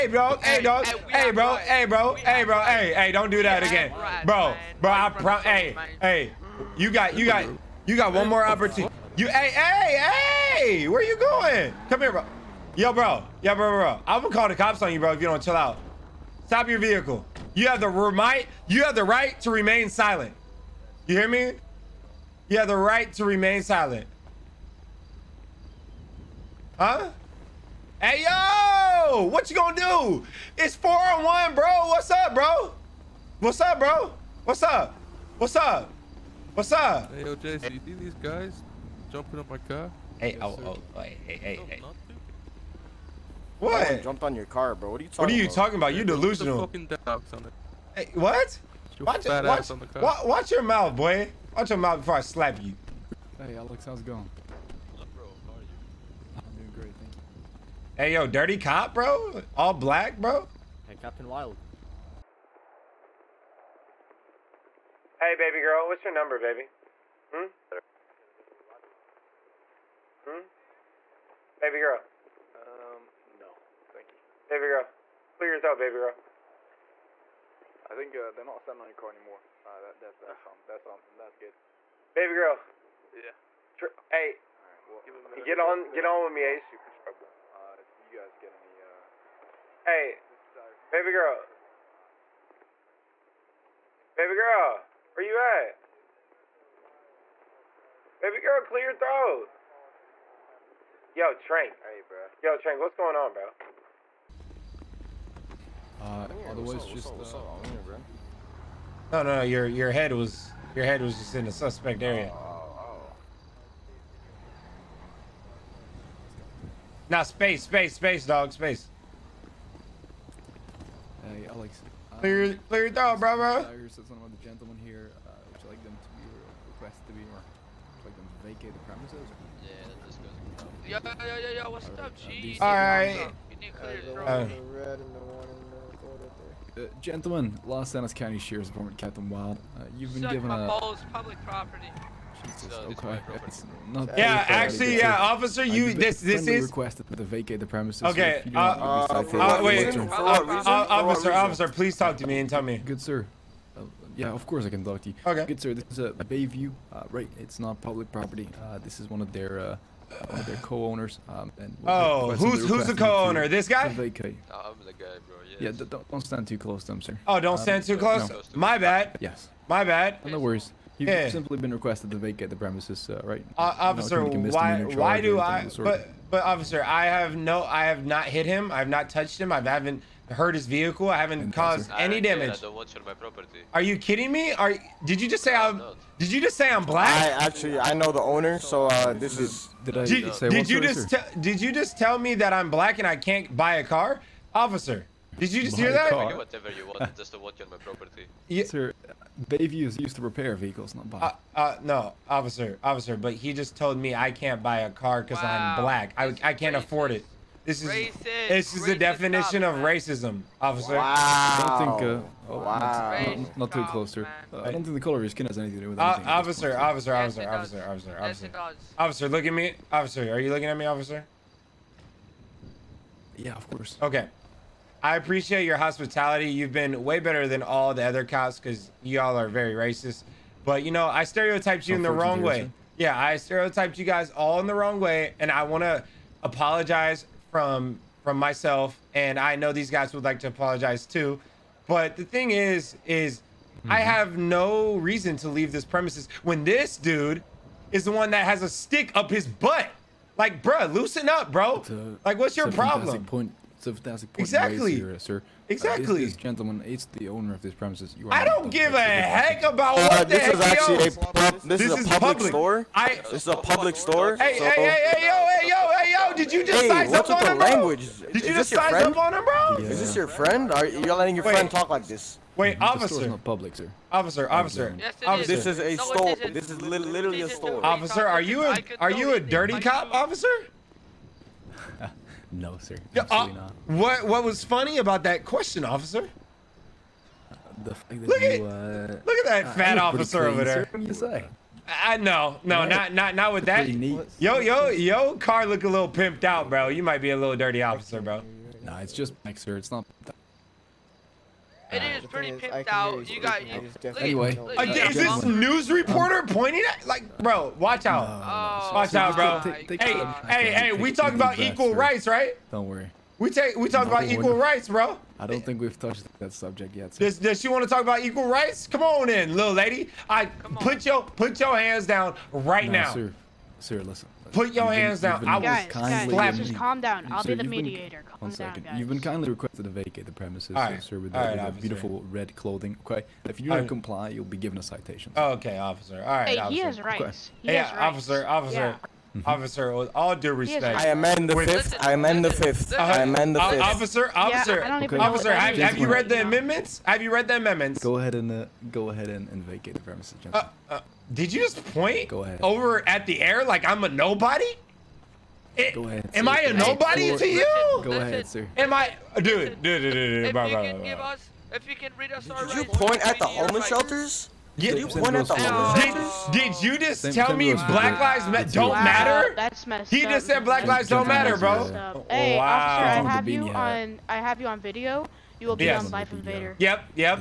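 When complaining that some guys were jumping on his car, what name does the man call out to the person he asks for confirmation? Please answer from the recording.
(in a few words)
JC.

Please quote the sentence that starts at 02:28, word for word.
Okay, so uh, uh, uh, wait, uh, officer, officer, please talk to me and tell me.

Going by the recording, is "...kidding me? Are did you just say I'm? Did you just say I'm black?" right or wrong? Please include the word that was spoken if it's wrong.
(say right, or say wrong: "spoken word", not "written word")
right.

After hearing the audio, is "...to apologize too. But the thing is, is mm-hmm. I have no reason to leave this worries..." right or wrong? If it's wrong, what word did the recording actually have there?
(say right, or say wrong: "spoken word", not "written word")
wrong: "premises", not "worries".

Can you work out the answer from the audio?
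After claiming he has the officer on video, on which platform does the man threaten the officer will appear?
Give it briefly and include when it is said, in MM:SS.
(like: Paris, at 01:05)
Life Invader, at 06:16.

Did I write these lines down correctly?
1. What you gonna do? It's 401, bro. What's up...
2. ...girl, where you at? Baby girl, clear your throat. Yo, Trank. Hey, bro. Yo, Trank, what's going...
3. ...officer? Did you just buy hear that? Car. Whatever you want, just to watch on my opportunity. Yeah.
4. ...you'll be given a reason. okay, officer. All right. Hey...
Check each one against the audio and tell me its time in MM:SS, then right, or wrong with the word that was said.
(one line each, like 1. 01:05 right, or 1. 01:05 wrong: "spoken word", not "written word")
1. 00:29 right
2. 01:34 right
3. 03:14 wrong: "property", not "opportunity"
4. 05:34 wrong: "citation", not "reason".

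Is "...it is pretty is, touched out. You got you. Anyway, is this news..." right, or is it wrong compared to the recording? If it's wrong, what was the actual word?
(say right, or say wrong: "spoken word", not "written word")
wrong: "pimped", not "touched".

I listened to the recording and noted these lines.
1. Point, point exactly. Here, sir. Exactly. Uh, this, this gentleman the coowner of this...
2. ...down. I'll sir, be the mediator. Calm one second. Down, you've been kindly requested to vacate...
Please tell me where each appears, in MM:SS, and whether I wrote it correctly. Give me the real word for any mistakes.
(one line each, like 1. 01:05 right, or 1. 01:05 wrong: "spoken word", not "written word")
1. 04:13 wrong: "owner", not "coowner"
2. 05:27 right.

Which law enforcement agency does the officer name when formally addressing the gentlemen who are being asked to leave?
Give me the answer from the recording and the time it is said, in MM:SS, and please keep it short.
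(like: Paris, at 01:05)
Los Angeles County Sheriff's Department, at 02:17.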